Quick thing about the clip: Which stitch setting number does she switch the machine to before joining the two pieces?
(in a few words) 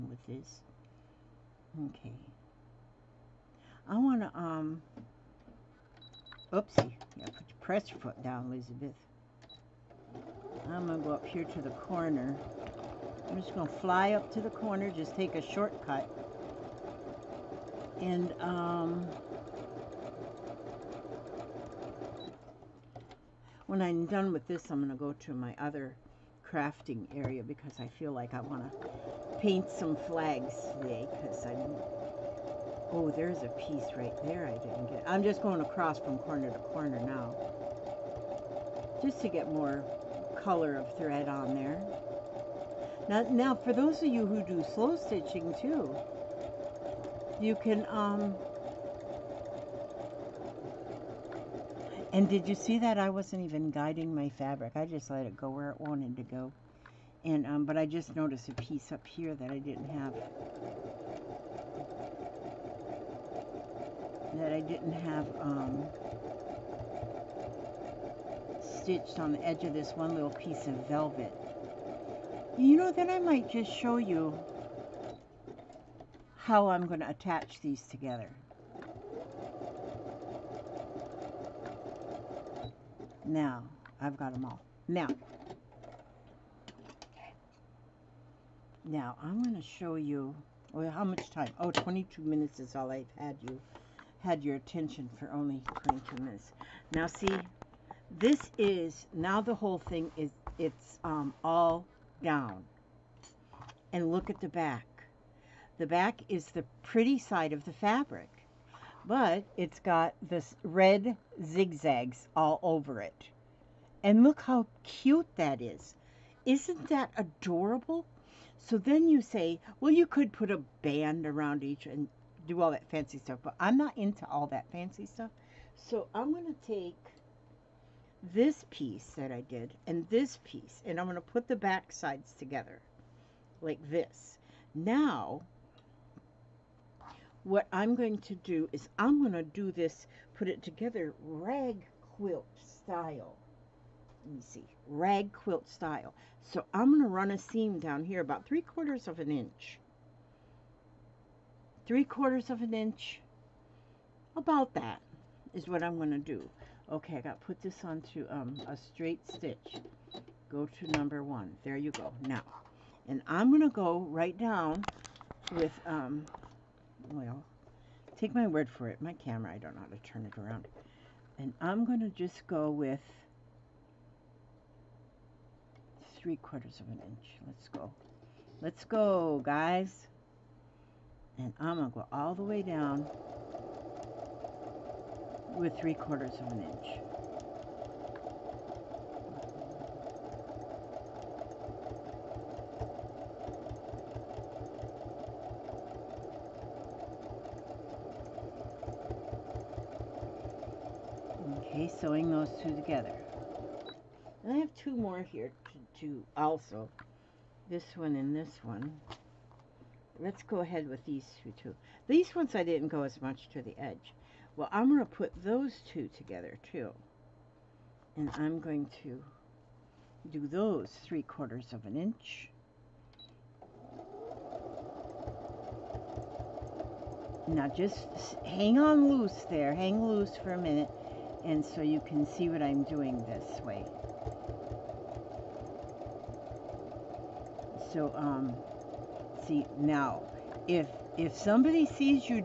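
1.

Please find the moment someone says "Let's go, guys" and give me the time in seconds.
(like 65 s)
178 s.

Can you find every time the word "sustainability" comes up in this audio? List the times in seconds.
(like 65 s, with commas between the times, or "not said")
not said.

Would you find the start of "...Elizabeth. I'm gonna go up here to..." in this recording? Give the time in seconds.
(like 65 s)
8 s.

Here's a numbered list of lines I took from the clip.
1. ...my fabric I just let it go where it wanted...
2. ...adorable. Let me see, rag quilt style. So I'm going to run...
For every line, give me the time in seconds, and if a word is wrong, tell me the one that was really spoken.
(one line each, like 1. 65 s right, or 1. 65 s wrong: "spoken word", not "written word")
1. 54 s right
2. 142 s wrong: "style", not "adorable".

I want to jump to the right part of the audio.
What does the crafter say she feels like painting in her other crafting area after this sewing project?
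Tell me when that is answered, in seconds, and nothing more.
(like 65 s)
30 s.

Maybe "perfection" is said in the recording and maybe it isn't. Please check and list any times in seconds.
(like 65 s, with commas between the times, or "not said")
not said.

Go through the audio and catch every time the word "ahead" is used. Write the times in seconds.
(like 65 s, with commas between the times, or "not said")
210 s.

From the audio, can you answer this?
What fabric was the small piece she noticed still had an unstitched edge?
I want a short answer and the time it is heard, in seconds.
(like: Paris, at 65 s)
velvet, at 70 s.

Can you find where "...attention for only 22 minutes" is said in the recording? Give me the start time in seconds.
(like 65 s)
94 s.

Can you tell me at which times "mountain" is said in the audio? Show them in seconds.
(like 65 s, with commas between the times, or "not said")
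not said.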